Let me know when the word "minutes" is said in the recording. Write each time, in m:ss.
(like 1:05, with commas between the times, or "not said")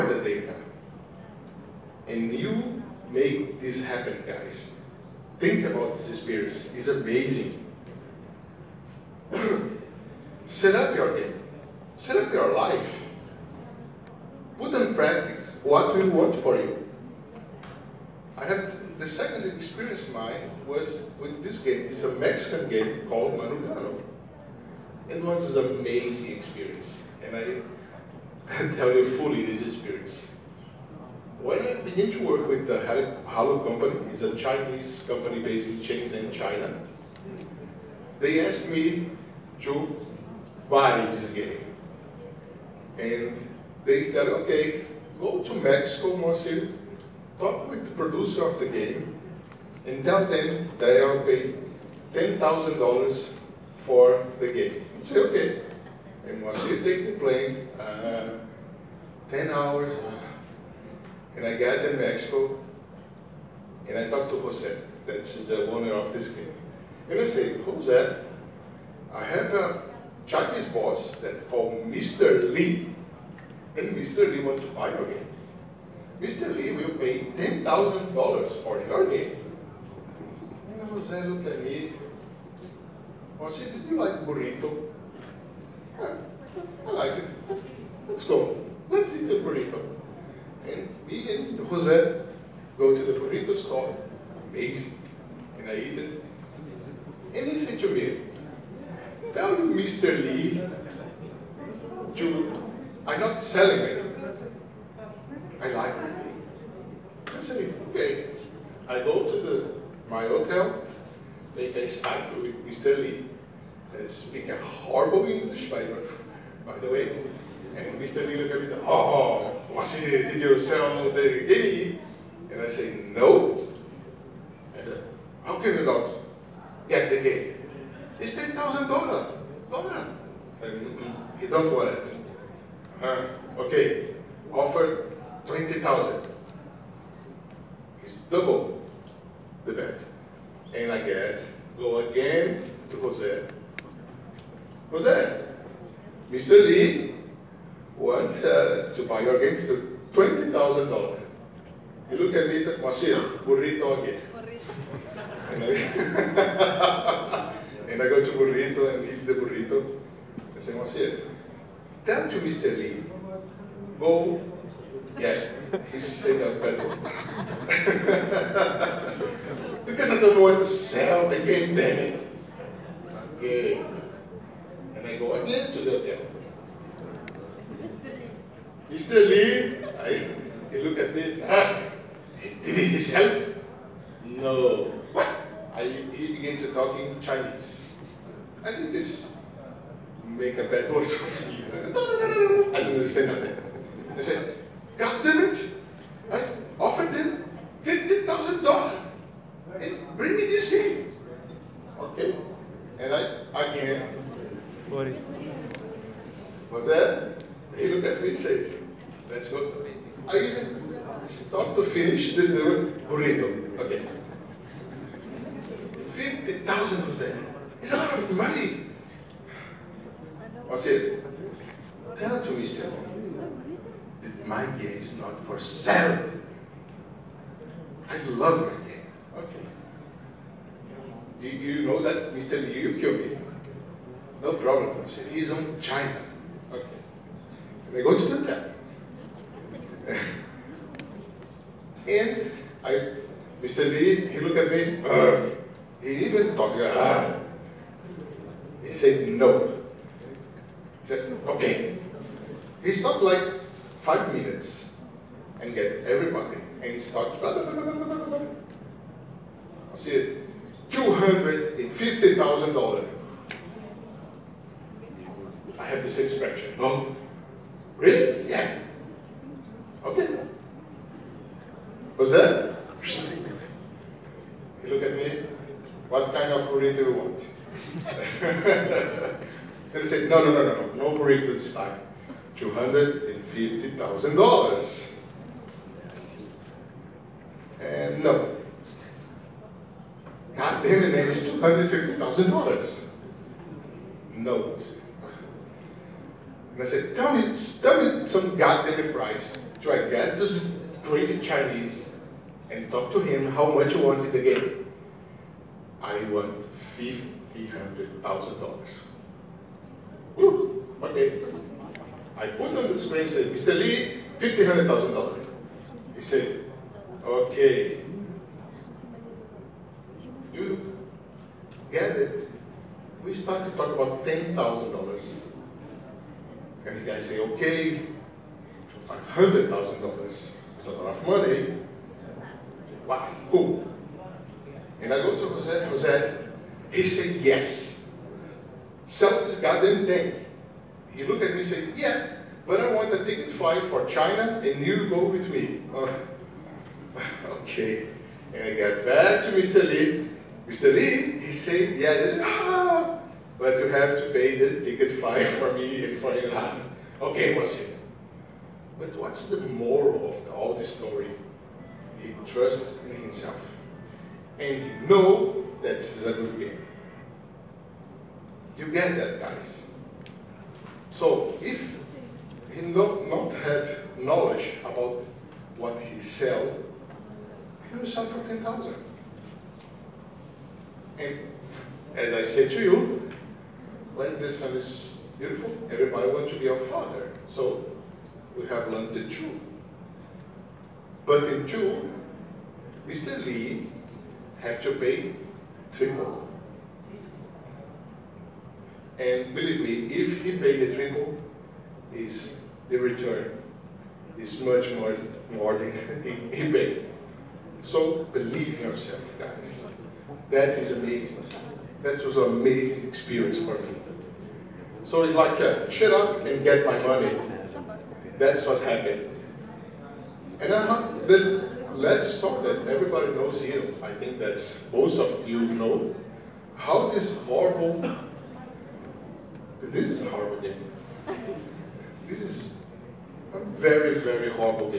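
4:14.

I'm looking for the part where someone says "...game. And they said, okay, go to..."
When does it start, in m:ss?
0:41.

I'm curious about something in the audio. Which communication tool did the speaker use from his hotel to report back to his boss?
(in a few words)
Skype.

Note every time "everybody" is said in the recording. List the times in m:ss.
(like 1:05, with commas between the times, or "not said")
4:16, 6:25, 7:02.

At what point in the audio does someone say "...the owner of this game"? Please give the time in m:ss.
1:05.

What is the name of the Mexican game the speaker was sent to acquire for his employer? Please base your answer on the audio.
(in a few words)
Manugano.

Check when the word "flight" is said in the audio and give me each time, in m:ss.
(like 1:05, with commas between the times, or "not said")
5:43, 5:55.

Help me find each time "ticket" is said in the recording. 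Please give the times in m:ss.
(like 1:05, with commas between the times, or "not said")
5:43, 5:54.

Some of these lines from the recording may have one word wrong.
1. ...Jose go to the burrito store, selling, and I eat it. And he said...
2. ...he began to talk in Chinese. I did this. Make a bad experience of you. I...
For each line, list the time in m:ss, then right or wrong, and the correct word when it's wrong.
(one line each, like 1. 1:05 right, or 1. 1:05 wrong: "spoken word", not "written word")
1. 1:31 wrong: "amazing", not "selling"
2. 3:06 wrong: "voice", not "experience".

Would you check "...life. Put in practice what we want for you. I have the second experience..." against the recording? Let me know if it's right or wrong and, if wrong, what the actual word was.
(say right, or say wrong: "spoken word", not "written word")
right.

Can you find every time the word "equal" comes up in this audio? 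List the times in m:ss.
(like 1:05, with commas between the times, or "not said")
not said.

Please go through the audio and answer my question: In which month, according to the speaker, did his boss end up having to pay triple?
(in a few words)
June.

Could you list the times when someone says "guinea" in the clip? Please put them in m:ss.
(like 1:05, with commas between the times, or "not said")
2:01.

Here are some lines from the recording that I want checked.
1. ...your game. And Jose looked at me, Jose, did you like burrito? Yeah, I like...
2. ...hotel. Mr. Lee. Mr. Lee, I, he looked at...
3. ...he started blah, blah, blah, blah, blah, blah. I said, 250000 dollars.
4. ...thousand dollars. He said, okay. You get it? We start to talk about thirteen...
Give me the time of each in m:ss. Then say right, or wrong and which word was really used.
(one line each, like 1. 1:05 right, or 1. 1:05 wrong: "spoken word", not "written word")
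1. 1:18 right
2. 2:55 right
3. 4:16 right
4. 5:14 wrong: "ten", not "thirteen".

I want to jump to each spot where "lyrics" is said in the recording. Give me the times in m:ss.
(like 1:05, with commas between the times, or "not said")
not said.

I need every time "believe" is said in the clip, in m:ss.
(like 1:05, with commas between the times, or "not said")
6:39, 6:48.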